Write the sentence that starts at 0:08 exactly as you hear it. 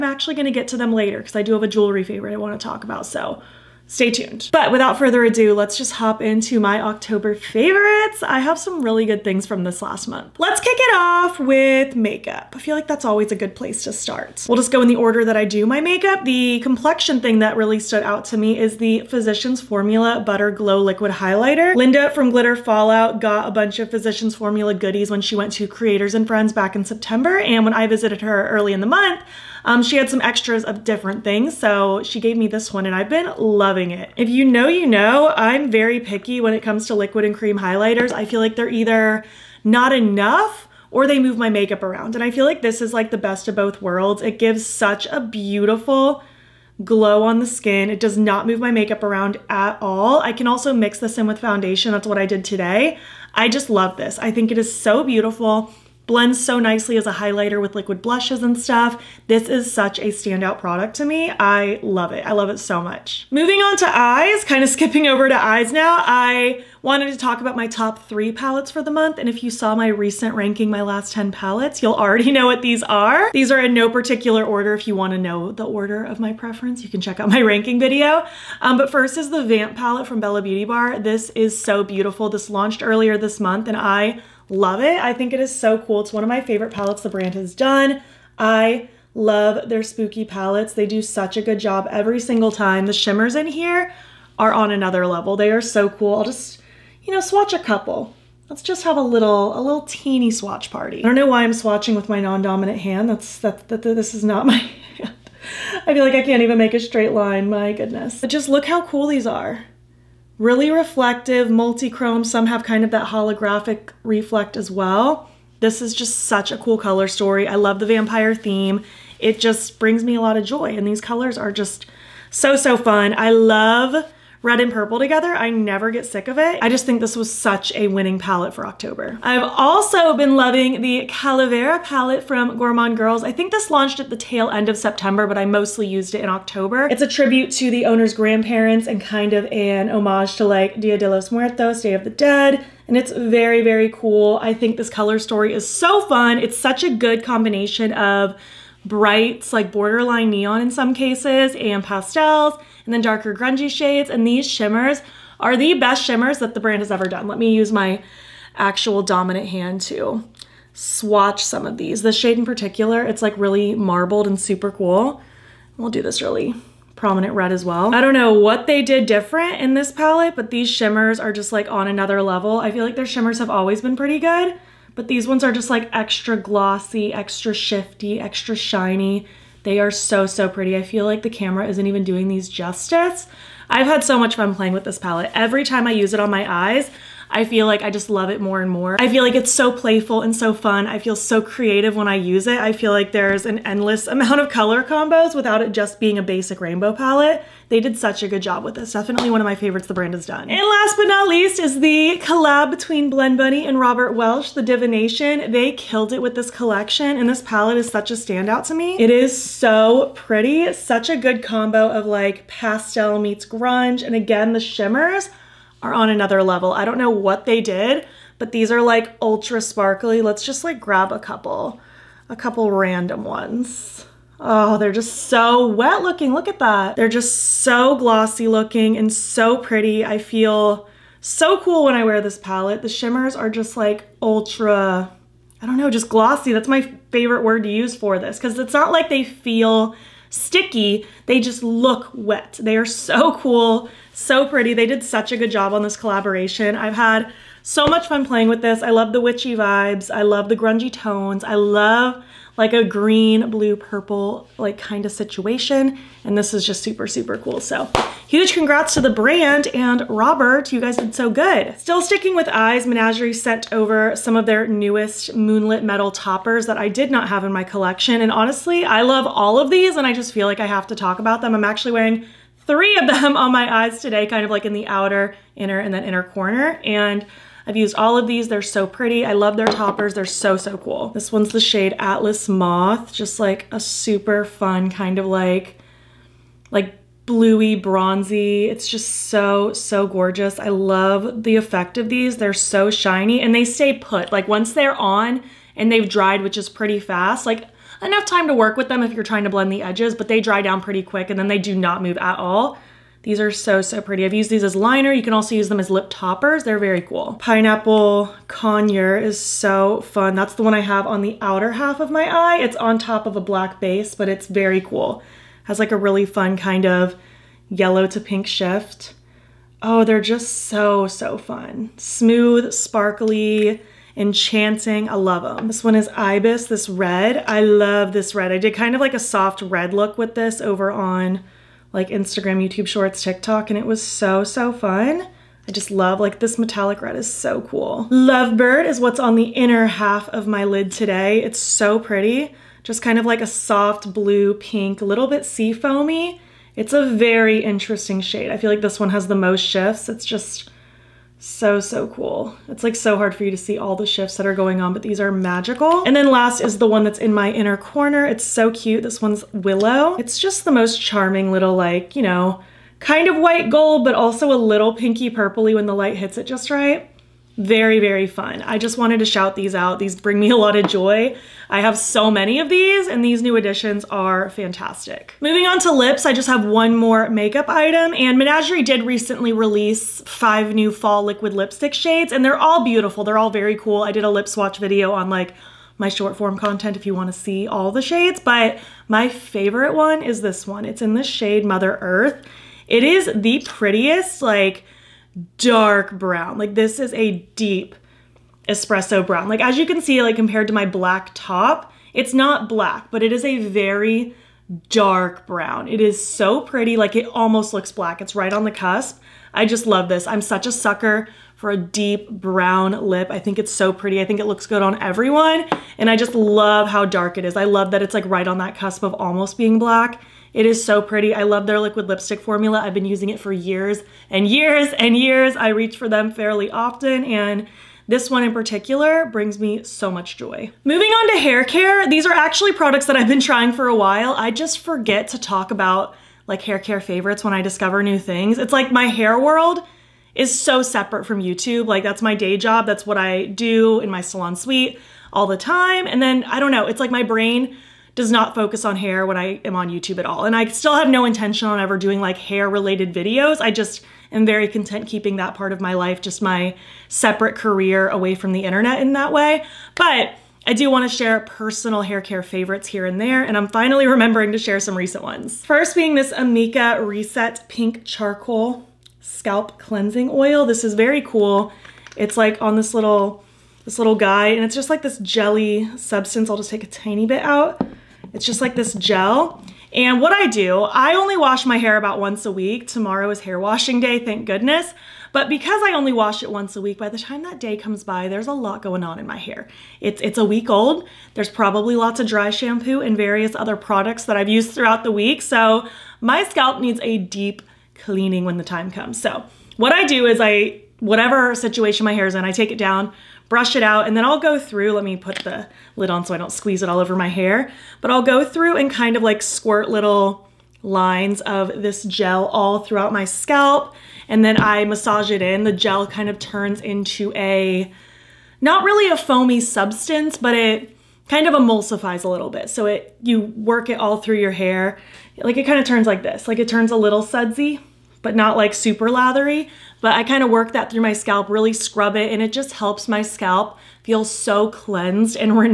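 I have some really good things from this last month.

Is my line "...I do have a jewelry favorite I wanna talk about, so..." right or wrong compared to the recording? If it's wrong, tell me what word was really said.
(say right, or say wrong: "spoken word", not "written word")
right.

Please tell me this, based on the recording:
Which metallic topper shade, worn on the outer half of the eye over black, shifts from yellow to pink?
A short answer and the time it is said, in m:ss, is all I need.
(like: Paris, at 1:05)
Pineapple Conure, at 5:07.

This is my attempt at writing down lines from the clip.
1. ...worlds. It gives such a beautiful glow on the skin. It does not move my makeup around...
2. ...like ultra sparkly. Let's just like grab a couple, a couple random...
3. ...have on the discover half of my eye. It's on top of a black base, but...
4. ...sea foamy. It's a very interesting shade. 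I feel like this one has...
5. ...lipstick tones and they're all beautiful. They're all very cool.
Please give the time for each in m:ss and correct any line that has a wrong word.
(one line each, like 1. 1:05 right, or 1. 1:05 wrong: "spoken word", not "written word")
1. 0:43 right
2. 3:38 right
3. 5:10 wrong: "outer", not "discover"
4. 5:45 right
5. 6:21 wrong: "shades", not "tones".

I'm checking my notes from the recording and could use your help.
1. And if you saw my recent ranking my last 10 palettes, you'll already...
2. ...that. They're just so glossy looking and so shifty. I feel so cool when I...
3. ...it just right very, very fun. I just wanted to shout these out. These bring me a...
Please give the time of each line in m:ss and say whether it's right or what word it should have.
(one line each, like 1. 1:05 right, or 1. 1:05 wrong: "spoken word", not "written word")
1. 1:09 right
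2. 3:46 wrong: "pretty", not "shifty"
3. 6:06 right.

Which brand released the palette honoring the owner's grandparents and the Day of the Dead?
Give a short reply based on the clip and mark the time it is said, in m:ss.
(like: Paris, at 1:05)
Gourmande Girls, at 2:12.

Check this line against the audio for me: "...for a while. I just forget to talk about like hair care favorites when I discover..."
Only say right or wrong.
right.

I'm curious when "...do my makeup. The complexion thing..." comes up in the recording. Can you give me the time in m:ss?
0:15.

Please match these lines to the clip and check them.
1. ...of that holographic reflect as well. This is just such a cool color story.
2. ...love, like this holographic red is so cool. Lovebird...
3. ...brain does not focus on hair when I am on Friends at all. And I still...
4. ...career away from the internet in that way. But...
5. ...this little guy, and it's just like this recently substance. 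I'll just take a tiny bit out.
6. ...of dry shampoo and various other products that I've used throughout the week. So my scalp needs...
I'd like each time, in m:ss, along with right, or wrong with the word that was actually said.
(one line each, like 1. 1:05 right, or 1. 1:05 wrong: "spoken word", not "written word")
1. 1:52 right
2. 5:35 wrong: "metallic", not "holographic"
3. 7:27 wrong: "YouTube", not "Friends"
4. 7:37 right
5. 7:53 wrong: "jelly", not "recently"
6. 8:12 right.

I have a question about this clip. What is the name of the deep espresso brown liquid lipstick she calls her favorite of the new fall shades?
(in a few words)
Mother Earth.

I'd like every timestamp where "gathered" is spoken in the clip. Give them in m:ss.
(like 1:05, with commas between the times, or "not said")
not said.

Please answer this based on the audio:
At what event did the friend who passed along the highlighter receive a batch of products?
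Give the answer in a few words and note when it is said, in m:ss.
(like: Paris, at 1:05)
Creators and Friends, at 0:25.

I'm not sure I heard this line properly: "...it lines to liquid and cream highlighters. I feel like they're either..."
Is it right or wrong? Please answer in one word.
wrong.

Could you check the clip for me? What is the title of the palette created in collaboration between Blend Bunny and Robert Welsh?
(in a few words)
The Divination.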